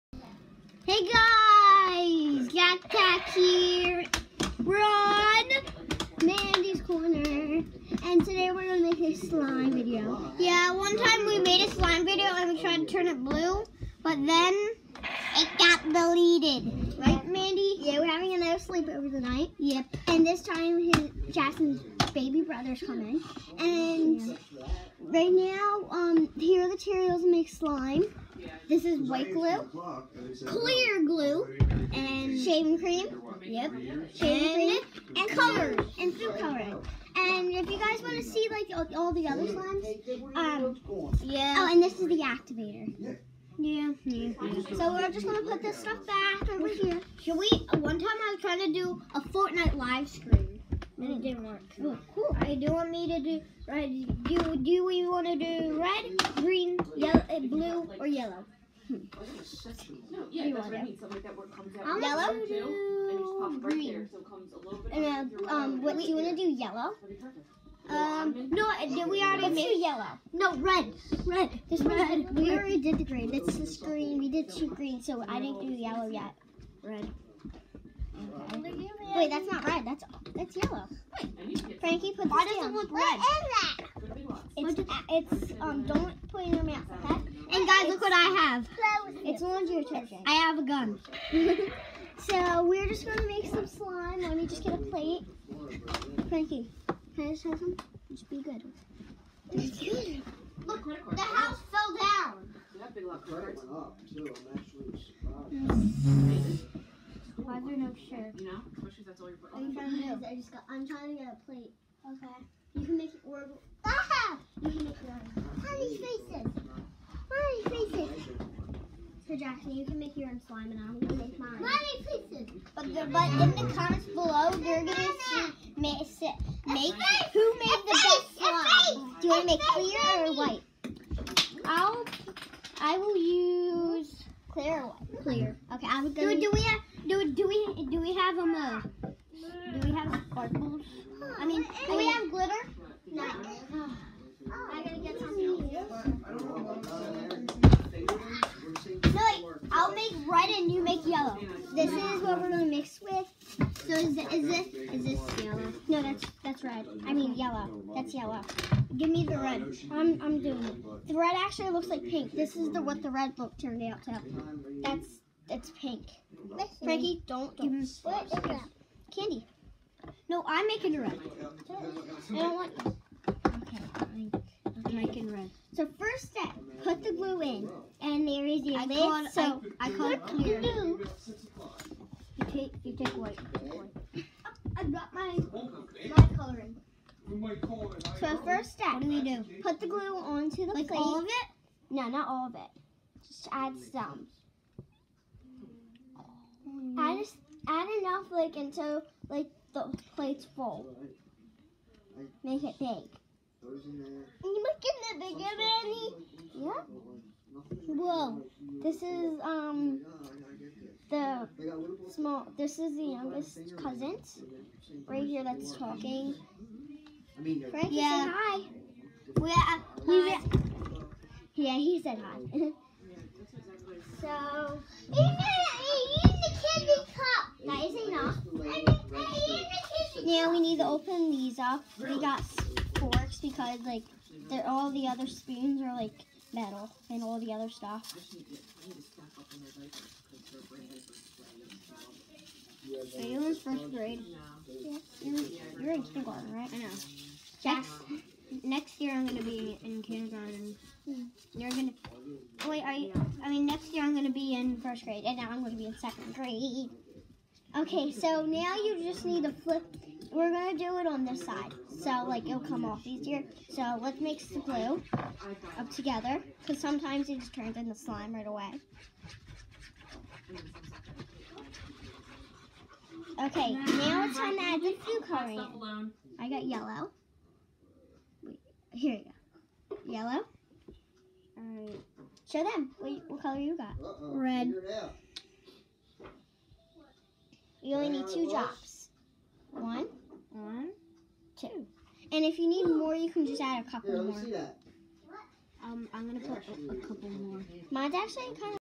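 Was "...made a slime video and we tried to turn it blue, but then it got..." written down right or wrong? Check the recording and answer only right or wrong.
right.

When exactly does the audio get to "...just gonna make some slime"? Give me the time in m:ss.
1:32.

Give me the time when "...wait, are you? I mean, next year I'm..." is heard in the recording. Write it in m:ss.
4:12.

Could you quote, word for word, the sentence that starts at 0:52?
I do want me to do Do do we want to do red, green, yellow, eh, blue, or yellow?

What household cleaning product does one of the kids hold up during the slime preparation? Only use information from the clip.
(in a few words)
Laundry detergent.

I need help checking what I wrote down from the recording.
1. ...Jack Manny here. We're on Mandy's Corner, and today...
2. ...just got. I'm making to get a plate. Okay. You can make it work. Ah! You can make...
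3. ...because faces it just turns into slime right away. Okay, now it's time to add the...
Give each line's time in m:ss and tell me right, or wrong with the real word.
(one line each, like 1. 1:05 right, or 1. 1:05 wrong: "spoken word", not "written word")
1. 0:02 wrong: "Jack", not "Manny"
2. 1:50 wrong: "trying", not "making"
3. 4:26 wrong: "sometimes", not "faces".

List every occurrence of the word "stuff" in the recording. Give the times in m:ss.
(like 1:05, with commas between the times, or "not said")
0:45, 3:57.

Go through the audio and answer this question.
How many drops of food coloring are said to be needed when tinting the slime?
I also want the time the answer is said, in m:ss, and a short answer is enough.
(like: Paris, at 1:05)
2, at 4:48.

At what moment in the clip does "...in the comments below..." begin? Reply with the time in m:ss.
2:03.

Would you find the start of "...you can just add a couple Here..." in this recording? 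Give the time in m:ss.
4:53.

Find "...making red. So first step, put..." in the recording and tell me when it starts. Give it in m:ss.
2:54.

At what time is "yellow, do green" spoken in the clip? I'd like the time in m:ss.
1:02.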